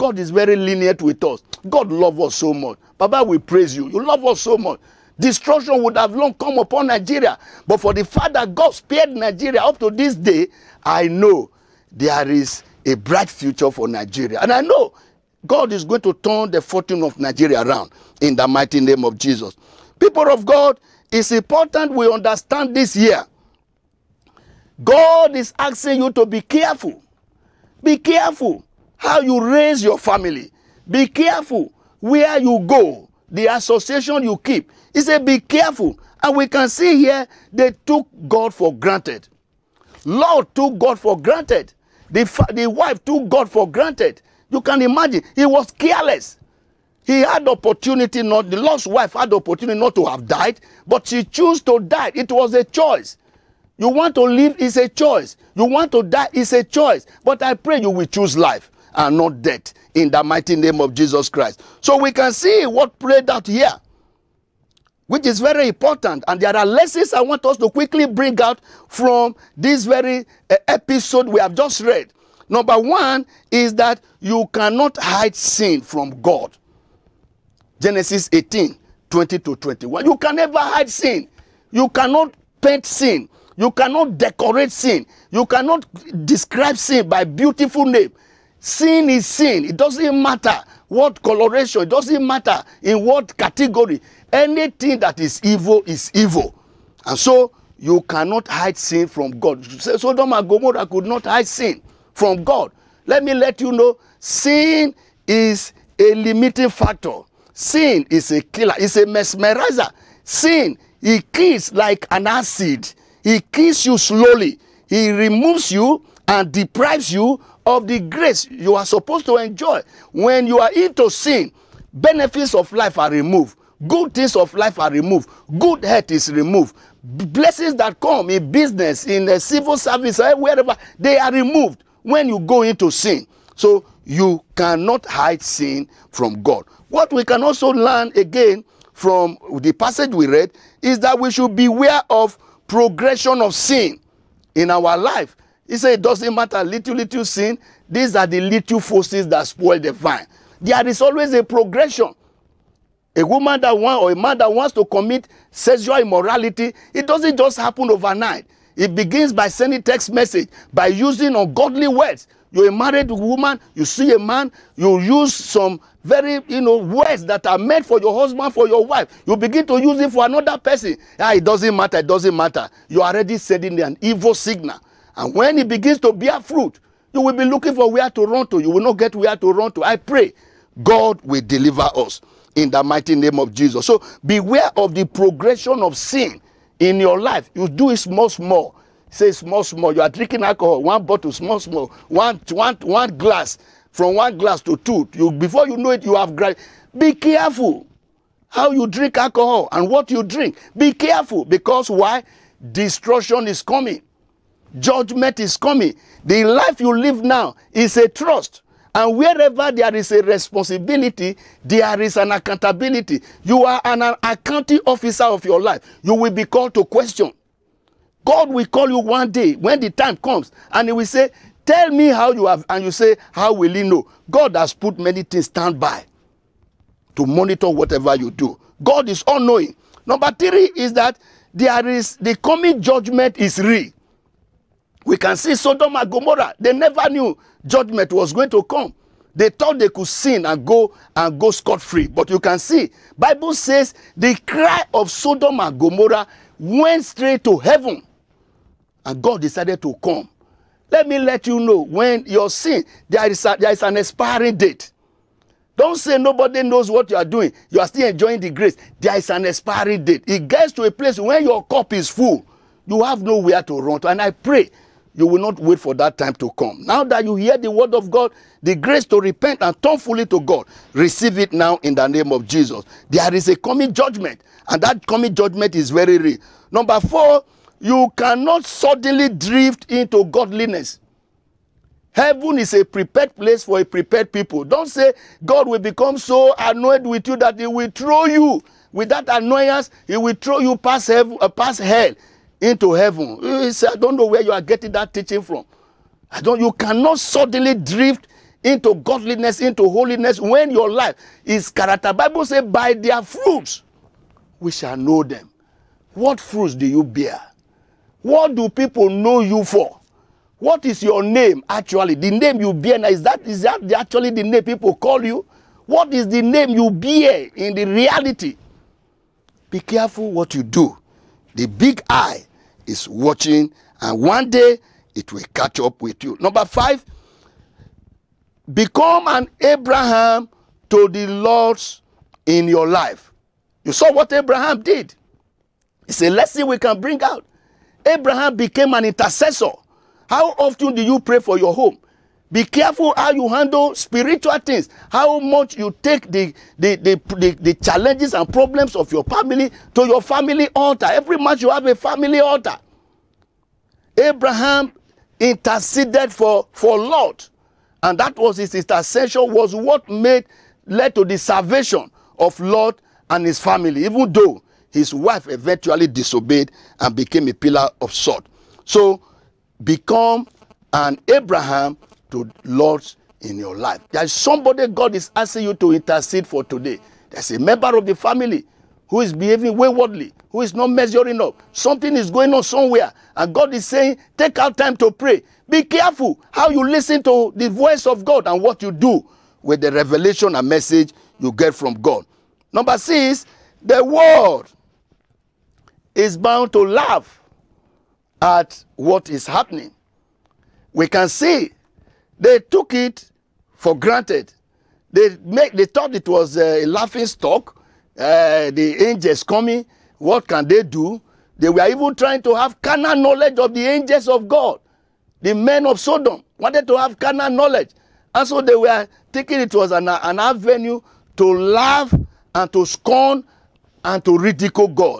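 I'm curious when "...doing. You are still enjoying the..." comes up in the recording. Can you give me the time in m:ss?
4:17.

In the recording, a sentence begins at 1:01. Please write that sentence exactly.
So we can see what prayed out here.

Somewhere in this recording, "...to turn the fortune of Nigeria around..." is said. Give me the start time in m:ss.
0:16.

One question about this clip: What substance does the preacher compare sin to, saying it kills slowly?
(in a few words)
acid.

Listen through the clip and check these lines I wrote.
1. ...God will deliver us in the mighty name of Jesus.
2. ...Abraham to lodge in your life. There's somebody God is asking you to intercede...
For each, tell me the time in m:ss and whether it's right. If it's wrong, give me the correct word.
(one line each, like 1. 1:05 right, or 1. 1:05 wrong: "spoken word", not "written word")
1. 3:00 right
2. 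6:11 right.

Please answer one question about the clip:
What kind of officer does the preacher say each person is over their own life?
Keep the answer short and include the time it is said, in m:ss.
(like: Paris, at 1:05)
accounting officer, at 3:34.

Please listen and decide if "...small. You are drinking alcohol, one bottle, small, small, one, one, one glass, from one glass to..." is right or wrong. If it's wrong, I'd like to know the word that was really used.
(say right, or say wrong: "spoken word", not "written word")
right.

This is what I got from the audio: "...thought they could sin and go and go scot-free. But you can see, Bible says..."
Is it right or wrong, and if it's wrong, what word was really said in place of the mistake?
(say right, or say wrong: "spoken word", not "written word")
right.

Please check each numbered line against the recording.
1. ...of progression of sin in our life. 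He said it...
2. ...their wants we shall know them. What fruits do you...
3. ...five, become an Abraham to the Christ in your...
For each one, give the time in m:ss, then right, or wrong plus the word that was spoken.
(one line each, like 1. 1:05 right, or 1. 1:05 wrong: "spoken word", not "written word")
1. 2:22 right
2. 5:02 wrong: "fruits", not "wants"
3. 5:26 wrong: "Lord", not "Christ".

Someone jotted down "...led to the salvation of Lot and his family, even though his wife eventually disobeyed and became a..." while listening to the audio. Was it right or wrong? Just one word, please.
right.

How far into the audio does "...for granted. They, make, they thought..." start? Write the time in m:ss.
6:43.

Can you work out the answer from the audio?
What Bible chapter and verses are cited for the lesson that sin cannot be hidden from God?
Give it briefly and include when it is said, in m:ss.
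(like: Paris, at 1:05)
Genesis 18:20-21, at 1:17.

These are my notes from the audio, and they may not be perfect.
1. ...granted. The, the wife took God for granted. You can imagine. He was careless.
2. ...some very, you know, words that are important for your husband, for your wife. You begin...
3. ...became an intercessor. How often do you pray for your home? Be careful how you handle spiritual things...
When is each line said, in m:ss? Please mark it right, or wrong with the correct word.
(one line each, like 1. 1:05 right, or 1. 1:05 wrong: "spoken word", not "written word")
1. 0:41 right
2. 2:45 wrong: "meant", not "important"
3. 5:38 right.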